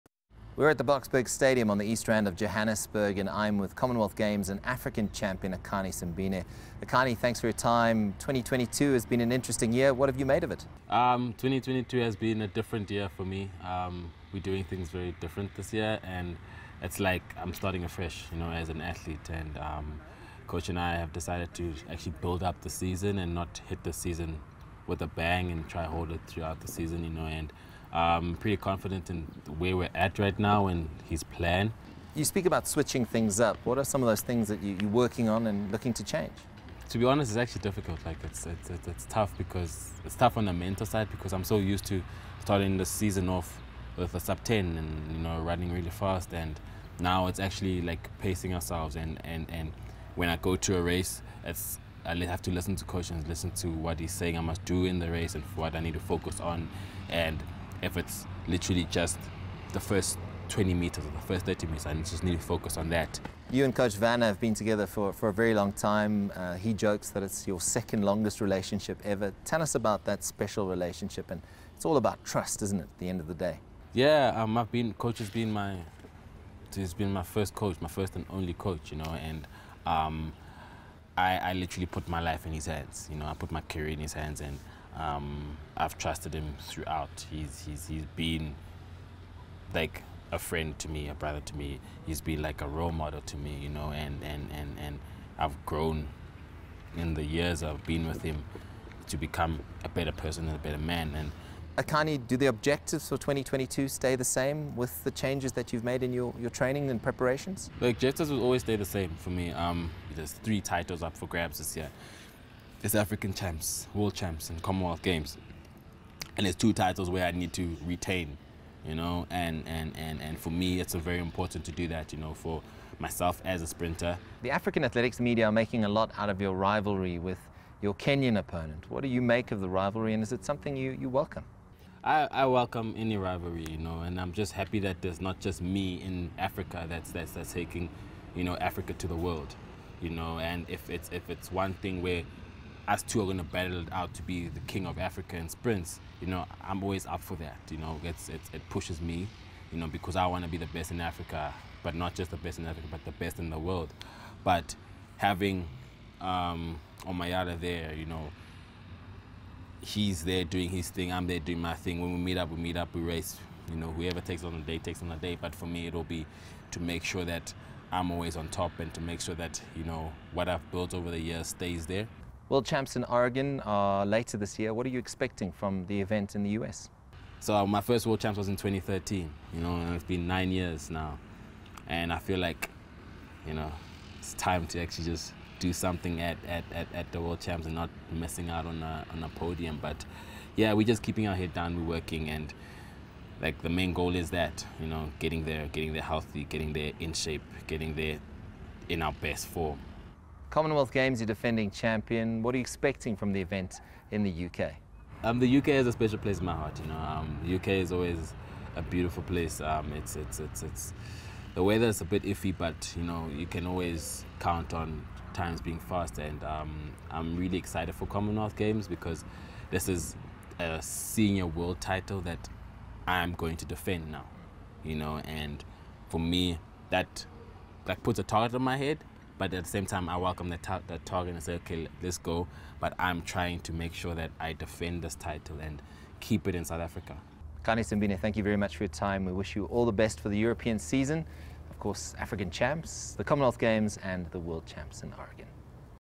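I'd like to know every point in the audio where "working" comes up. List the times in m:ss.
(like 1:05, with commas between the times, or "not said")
0:34, 3:11.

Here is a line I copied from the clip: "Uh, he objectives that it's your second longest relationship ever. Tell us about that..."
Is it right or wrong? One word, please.
wrong.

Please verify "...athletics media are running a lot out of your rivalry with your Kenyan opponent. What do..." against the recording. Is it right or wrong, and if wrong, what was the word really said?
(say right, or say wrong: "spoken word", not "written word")
wrong: "making", not "running".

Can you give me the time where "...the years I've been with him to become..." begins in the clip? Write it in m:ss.
1:37.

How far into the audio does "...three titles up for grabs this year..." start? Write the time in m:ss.
1:50.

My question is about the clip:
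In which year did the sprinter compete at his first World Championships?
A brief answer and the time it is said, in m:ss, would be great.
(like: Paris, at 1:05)
2013, at 2:58.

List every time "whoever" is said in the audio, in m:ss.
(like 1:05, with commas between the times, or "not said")
2:43.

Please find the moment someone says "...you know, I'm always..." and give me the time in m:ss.
2:26.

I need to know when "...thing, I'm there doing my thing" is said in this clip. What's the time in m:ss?
2:40.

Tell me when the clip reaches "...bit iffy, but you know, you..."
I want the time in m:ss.
3:32.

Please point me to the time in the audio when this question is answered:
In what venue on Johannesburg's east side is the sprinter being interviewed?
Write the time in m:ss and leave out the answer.
0:00.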